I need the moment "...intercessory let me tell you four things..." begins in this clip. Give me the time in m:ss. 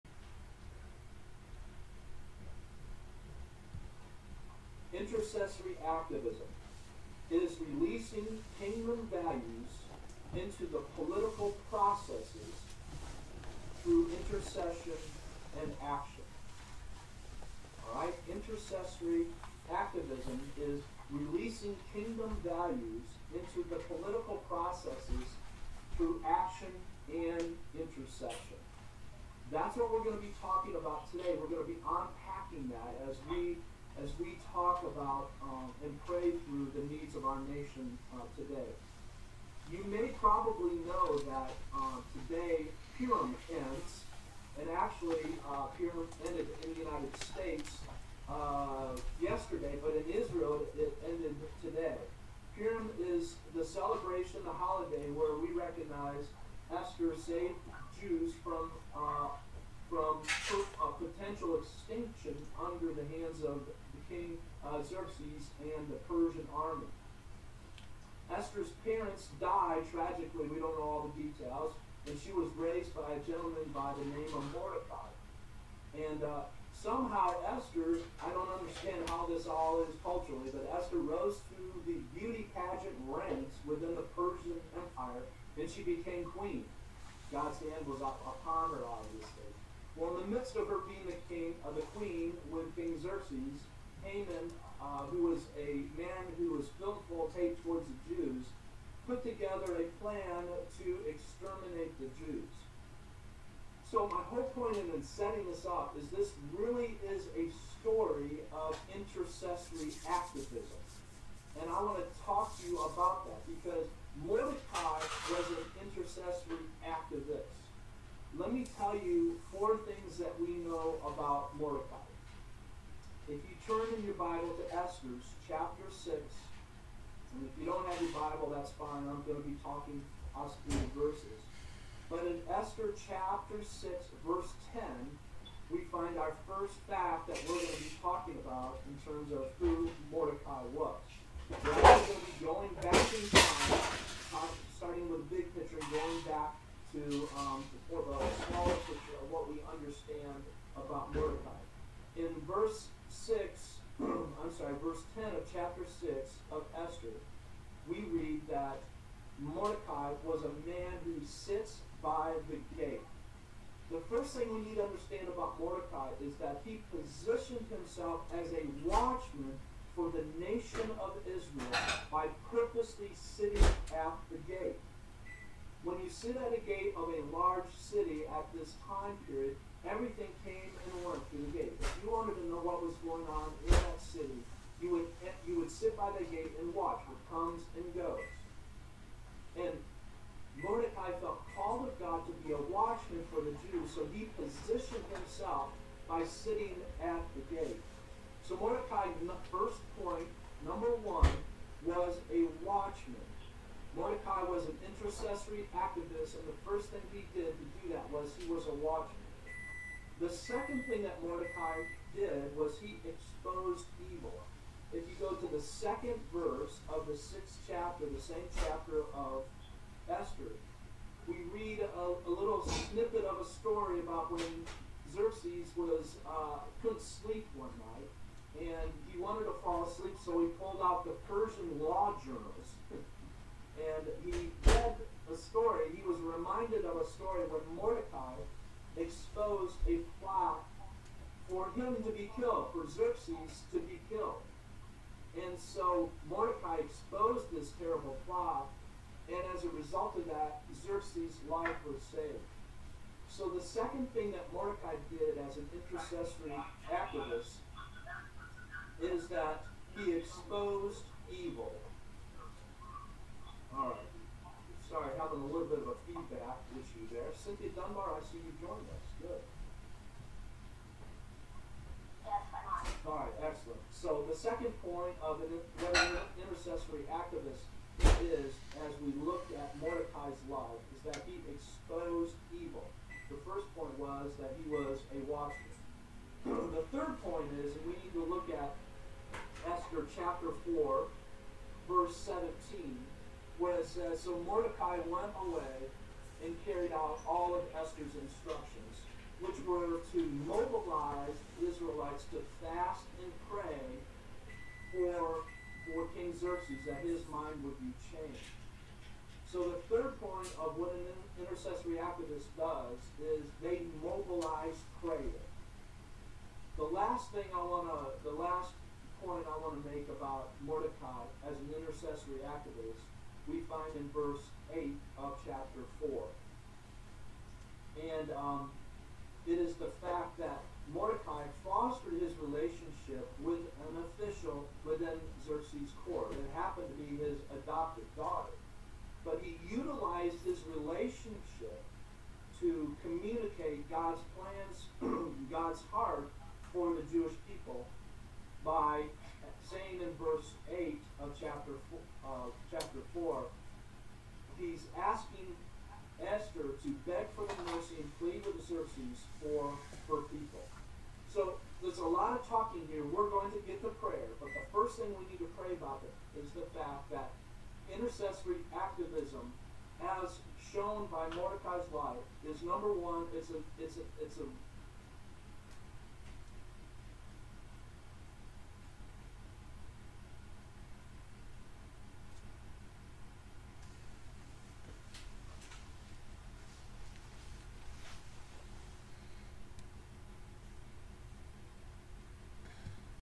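1:55.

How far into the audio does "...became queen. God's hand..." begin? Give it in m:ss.
1:25.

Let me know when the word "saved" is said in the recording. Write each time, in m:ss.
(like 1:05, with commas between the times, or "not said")
0:57, 4:12.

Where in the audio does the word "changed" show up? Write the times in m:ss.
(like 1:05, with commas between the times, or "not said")
5:08.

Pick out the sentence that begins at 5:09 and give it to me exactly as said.
So the third point of what an intercessory activist does is they mobilize prayer.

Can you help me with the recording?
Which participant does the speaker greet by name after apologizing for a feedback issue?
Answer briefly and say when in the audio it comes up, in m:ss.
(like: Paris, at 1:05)
Cynthia Dunbar, at 4:27.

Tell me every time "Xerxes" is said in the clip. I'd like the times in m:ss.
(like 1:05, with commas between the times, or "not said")
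1:04, 1:33, 3:45, 4:02, 4:10, 5:06, 5:58.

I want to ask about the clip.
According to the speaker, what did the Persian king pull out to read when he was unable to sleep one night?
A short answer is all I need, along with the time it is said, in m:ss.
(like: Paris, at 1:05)
Persian law journals, at 3:51.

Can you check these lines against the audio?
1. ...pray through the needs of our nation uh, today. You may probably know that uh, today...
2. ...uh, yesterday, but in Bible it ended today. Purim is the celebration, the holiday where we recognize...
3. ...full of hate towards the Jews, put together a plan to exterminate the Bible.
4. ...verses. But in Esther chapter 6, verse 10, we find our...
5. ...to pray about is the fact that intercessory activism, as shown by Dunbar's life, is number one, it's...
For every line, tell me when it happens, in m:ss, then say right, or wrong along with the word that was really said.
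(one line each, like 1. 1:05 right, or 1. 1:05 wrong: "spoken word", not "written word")
1. 0:36 right
2. 0:48 wrong: "Israel", not "Bible"
3. 1:37 wrong: "Jews", not "Bible"
4. 2:10 right
5. 6:05 wrong: "Mordecai", not "Dunbar".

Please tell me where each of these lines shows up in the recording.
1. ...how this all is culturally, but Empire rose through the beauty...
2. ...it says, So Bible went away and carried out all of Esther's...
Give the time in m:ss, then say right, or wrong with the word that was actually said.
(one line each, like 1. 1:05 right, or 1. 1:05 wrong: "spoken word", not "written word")
1. 1:19 wrong: "Esther", not "Empire"
2. 4:53 wrong: "Mordecai", not "Bible".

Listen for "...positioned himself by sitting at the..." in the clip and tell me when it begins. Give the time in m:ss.
3:14.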